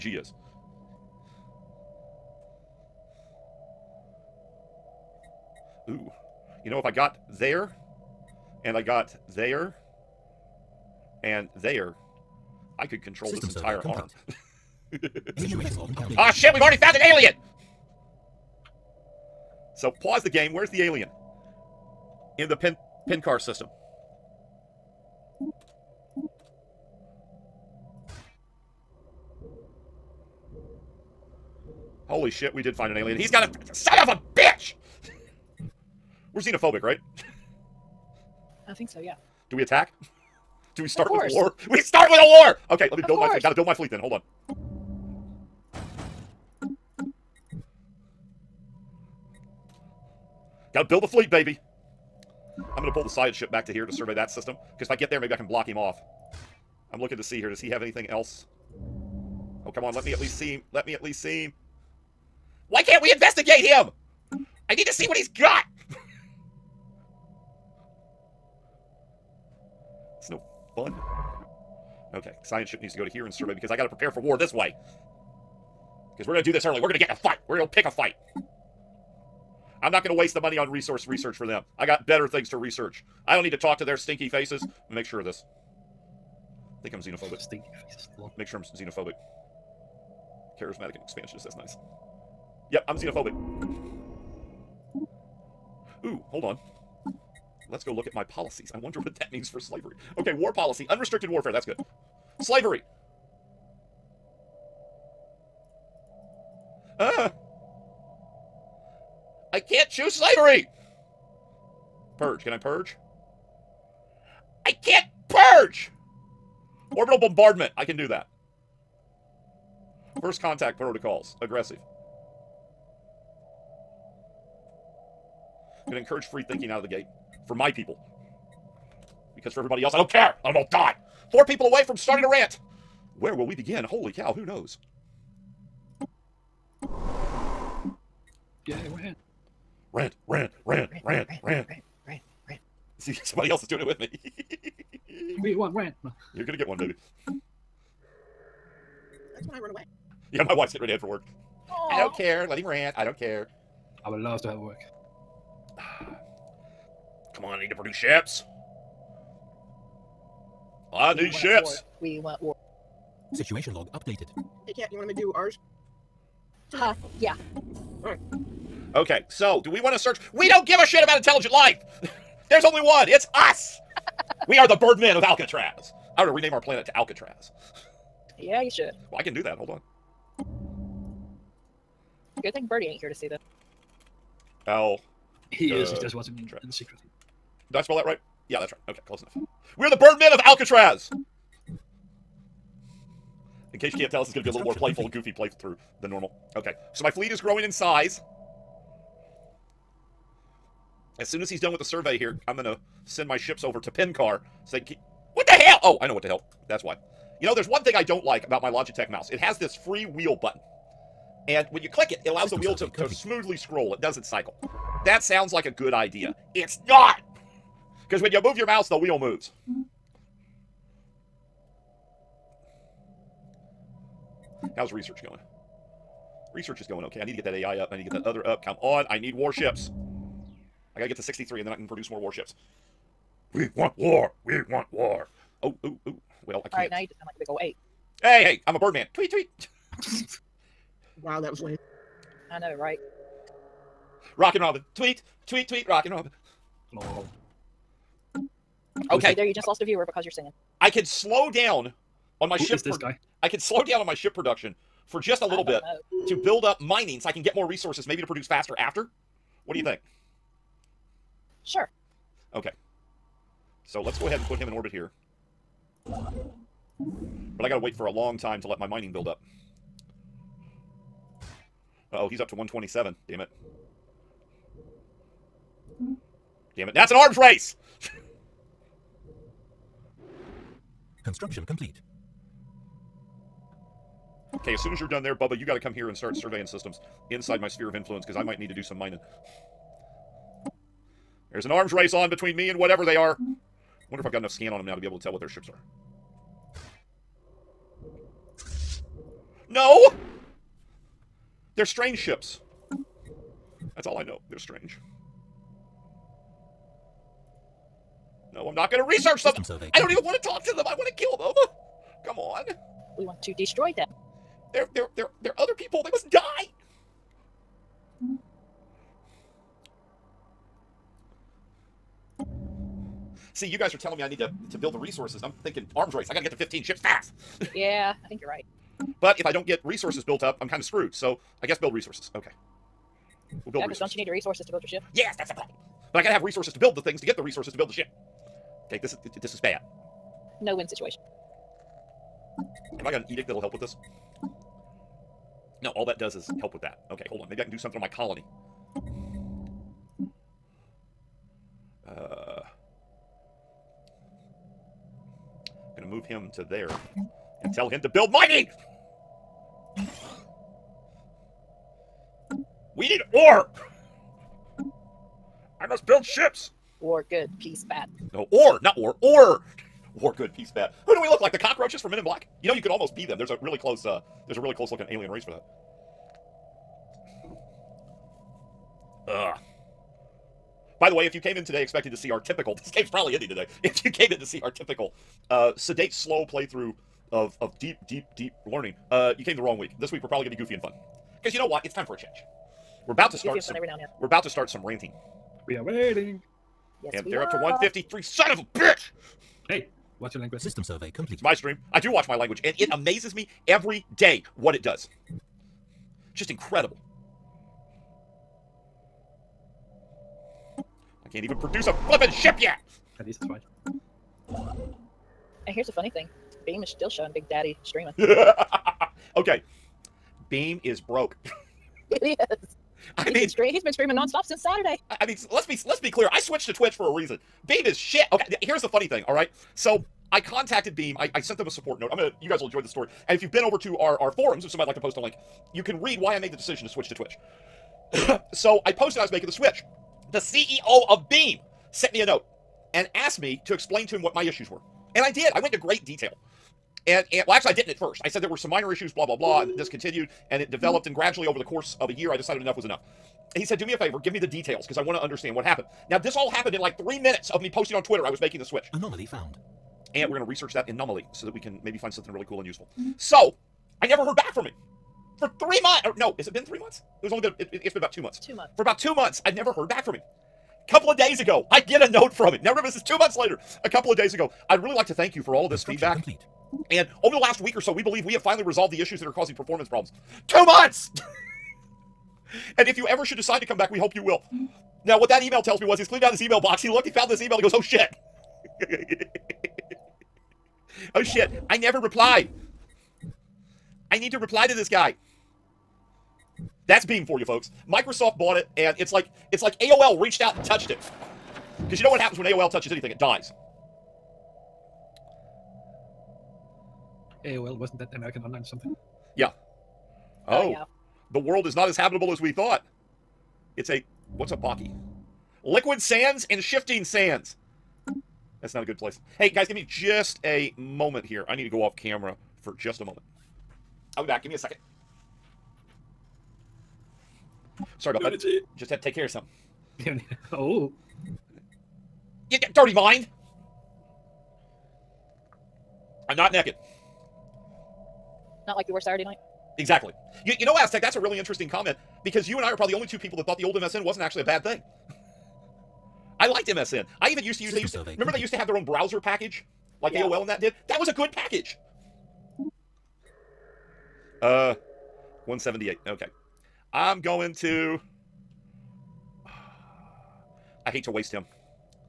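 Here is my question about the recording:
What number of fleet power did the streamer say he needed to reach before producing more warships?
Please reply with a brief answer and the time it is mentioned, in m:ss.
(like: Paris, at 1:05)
63, at 3:51.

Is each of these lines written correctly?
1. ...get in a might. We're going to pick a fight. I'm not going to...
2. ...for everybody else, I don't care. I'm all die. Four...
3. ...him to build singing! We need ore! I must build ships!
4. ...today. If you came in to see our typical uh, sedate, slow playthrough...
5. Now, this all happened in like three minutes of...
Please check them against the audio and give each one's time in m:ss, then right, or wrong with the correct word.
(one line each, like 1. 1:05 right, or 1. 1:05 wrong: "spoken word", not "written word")
1. 1:16 wrong: "fight", not "might"
2. 2:09 right
3. 5:57 wrong: "mining", not "singing"
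4. 6:23 right
5. 7:36 right.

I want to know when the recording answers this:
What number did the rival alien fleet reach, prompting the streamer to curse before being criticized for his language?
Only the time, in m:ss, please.
6:37.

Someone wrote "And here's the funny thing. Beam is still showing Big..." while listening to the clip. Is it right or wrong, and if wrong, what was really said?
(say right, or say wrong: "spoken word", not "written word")
right.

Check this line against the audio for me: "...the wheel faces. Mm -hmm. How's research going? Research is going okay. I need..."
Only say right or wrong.
wrong.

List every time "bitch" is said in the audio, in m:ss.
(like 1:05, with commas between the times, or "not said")
0:34, 6:38.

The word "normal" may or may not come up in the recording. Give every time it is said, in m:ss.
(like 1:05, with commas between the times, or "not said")
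3:16.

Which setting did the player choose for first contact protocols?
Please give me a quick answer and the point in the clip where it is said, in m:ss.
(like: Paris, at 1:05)
Aggressive, at 2:01.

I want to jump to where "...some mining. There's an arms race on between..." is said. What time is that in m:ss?
4:48.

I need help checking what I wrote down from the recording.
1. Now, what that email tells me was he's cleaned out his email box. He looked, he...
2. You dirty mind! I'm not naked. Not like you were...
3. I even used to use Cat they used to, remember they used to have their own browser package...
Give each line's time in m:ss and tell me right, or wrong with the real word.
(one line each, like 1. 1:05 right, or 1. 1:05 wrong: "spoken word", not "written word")
1. 8:05 right
2. 8:52 right
3. 9:07 wrong: "System", not "Cat".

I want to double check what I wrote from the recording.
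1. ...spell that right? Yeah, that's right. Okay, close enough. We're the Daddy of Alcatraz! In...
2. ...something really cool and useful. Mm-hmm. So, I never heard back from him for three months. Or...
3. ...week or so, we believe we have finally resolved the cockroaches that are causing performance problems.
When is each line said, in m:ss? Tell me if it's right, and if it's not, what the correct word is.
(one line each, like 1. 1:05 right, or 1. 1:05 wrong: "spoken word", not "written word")
1. 3:07 wrong: "Birdmen", not "Daddy"
2. 7:42 right
3. 7:57 wrong: "issues", not "cockroaches".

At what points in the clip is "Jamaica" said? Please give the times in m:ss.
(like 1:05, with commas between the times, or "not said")
not said.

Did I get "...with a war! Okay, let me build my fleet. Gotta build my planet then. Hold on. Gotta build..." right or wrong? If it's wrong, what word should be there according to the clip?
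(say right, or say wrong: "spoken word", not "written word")
wrong: "fleet", not "planet".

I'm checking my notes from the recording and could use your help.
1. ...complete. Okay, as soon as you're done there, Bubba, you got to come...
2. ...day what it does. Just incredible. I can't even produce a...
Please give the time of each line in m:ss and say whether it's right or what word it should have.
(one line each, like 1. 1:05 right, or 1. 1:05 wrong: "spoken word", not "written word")
1. 4:41 right
2. 6:44 right.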